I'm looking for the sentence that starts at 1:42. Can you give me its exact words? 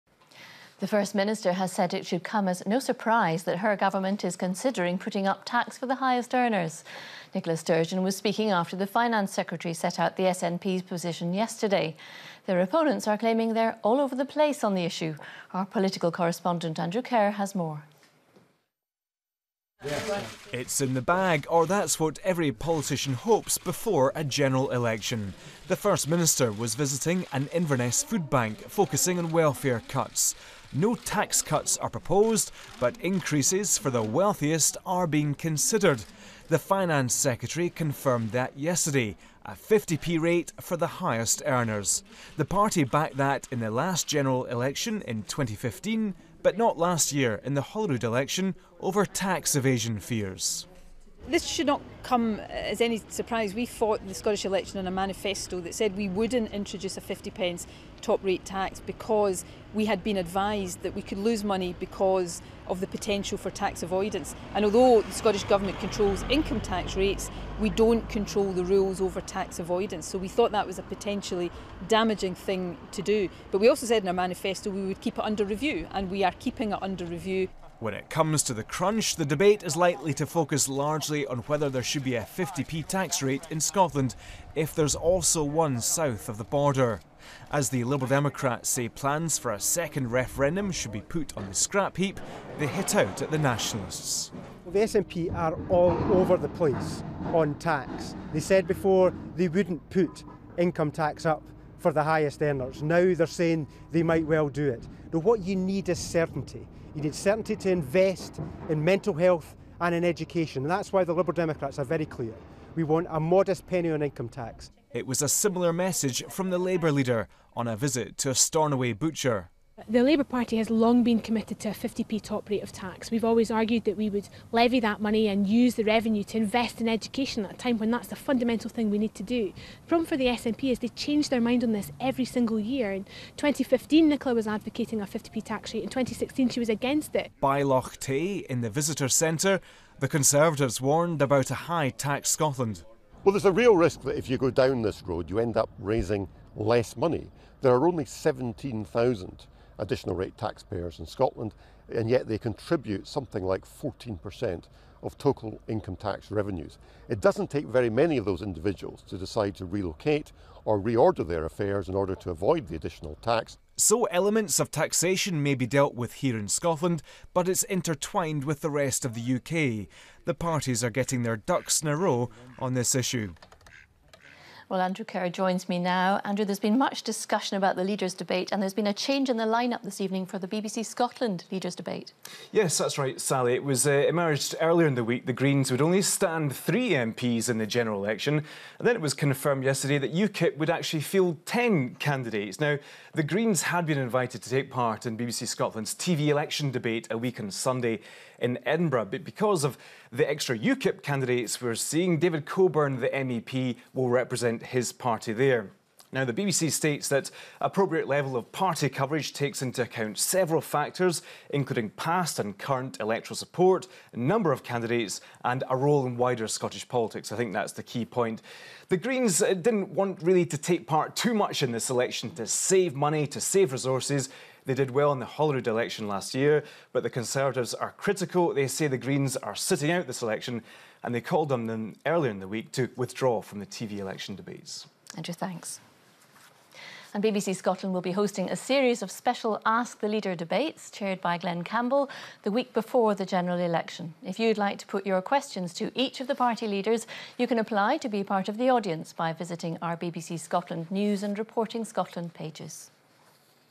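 Now they're saying they might well do it.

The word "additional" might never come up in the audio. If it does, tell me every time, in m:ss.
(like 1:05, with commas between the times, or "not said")
2:29, 2:42.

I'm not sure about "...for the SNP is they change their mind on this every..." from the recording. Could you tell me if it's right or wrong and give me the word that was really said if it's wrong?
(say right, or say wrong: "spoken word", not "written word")
right.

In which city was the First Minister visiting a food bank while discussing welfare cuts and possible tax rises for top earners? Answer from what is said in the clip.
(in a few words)
Inverness.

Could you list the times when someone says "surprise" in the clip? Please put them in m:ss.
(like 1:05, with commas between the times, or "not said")
0:02, 0:53.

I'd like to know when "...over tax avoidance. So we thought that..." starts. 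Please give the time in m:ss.
1:08.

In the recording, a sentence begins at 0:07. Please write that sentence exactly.
Nicola Sturgeon was speaking after the Finance Secretary set out the SNP's position yesterday.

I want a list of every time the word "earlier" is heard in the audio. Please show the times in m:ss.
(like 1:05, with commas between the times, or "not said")
3:04, 3:52.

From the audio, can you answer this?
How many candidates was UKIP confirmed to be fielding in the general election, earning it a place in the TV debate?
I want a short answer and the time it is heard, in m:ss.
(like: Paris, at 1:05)
10, at 3:11.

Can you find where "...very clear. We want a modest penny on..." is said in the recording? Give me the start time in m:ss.
1:51.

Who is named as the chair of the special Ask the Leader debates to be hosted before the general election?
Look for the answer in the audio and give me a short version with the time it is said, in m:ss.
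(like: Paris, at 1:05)
Glenn Campbell, at 4:01.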